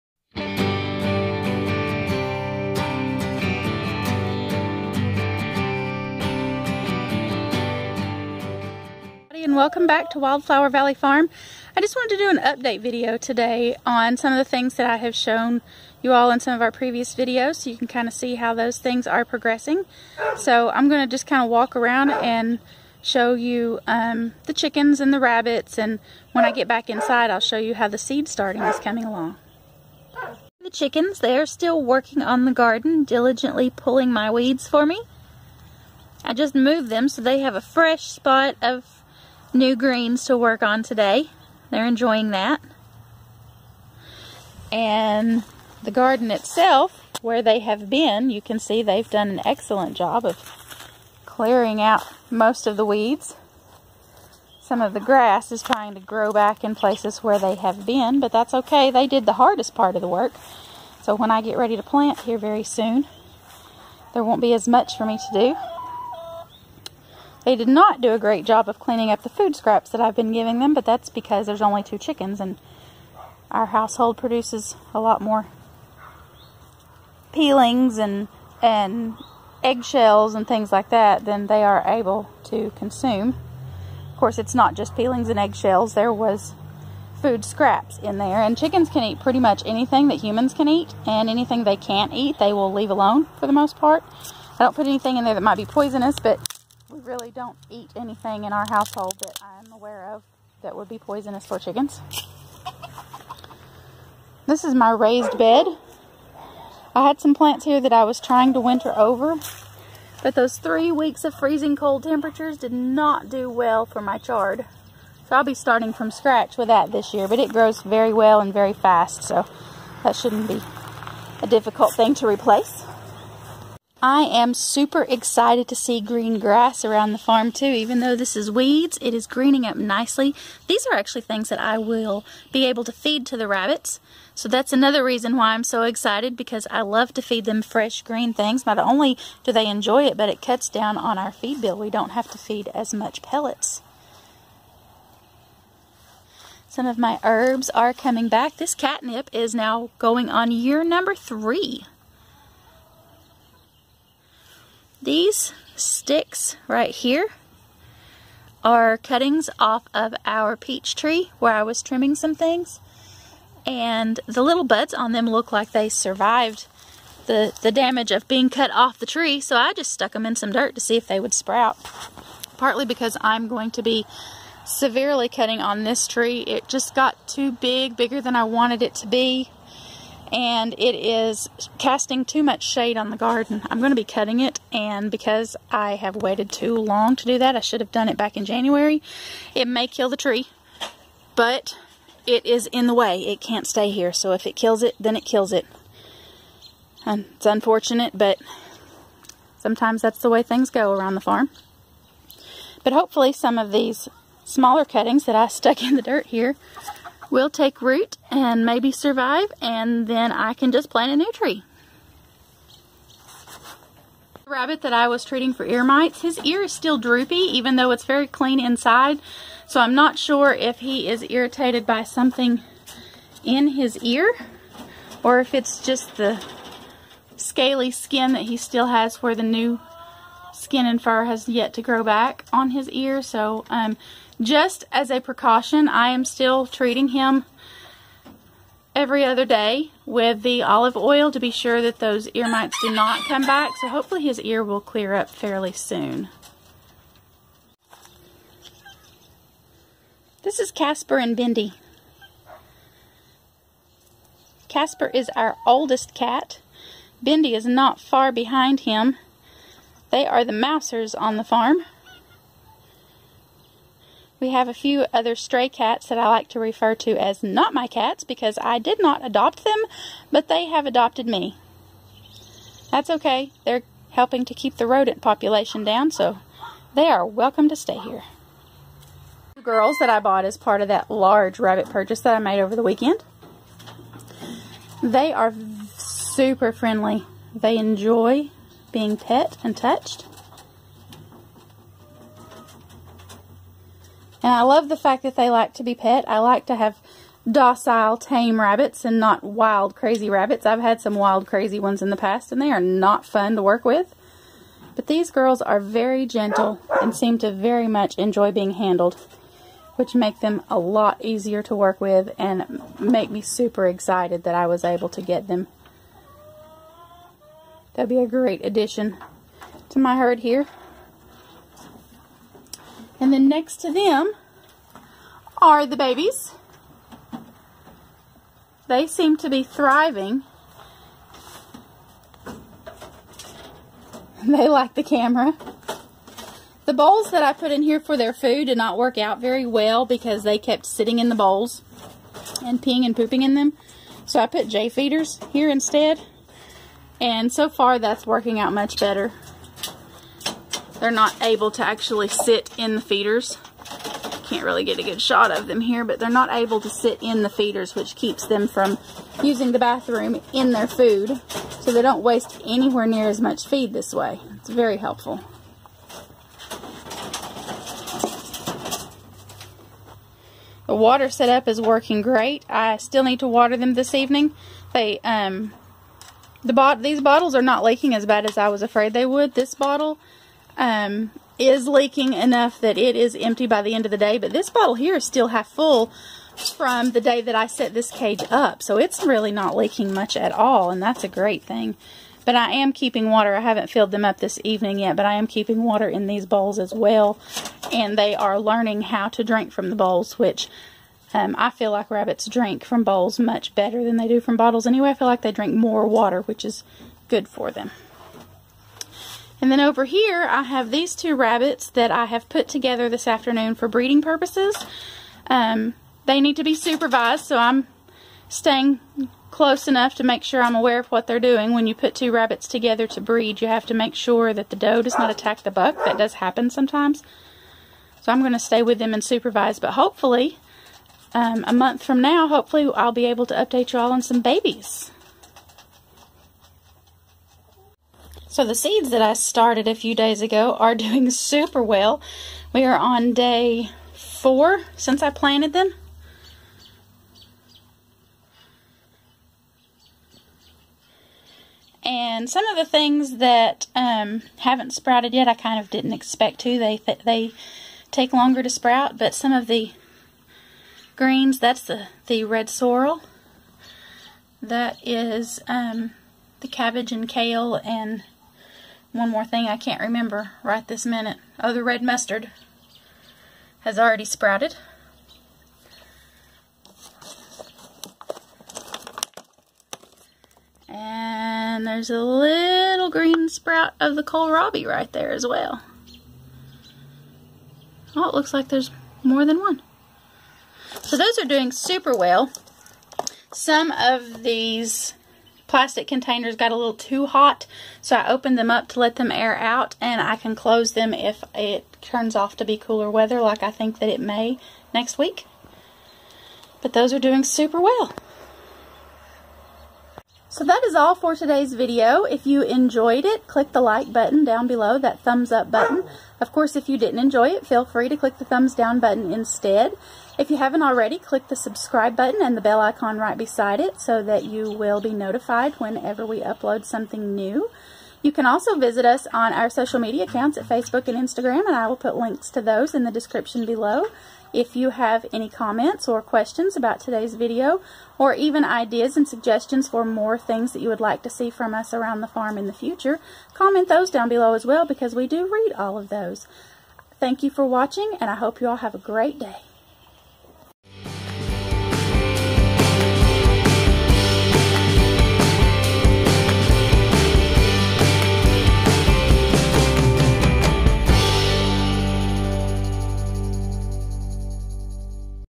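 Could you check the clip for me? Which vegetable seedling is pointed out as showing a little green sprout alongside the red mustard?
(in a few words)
Kohlrabi.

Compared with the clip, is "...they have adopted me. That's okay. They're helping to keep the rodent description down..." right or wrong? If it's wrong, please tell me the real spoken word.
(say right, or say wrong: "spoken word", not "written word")
wrong: "population", not "description".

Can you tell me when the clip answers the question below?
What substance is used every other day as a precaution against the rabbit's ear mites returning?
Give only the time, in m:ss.
4:00.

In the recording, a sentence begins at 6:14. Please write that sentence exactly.
They um, the bot these bottles are not leaking as bad as I was afraid they would.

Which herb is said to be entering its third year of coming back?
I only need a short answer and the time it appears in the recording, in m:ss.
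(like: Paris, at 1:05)
Catnip, at 2:28.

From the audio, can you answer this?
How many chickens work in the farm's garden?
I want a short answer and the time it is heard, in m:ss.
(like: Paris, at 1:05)
2, at 1:11.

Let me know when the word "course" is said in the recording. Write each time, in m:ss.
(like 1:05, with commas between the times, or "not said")
1:24, 8:36.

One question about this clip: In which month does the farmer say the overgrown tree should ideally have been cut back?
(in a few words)
January.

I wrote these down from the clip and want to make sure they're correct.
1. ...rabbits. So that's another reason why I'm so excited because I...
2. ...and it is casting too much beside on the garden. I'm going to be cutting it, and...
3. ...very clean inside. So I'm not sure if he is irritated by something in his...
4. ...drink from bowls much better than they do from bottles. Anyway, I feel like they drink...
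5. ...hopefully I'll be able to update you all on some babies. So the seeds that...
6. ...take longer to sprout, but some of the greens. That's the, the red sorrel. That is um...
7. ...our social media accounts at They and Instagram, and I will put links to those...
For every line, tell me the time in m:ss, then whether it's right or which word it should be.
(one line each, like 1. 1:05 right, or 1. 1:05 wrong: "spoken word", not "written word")
1. 2:13 right
2. 3:00 wrong: "shade", not "beside"
3. 3:38 right
4. 6:42 right
5. 7:12 right
6. 7:38 right
7. 8:49 wrong: "Facebook", not "They".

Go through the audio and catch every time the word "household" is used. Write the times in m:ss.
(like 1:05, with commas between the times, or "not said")
1:13, 1:38.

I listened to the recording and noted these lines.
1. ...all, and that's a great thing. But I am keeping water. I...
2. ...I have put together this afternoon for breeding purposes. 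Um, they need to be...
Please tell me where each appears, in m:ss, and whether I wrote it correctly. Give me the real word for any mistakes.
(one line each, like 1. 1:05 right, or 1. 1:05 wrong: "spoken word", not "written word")
1. 6:30 right
2. 6:52 right.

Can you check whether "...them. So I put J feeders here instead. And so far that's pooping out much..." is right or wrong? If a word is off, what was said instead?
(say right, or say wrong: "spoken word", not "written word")
wrong: "working", not "pooping".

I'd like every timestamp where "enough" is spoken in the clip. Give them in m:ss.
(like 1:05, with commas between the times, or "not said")
6:22, 6:59.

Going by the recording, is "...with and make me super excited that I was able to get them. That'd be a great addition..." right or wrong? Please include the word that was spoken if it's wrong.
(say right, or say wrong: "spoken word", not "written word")
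right.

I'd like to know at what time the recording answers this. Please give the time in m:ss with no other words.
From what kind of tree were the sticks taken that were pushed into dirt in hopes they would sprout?
2:40.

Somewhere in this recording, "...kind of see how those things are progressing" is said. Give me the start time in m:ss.
0:17.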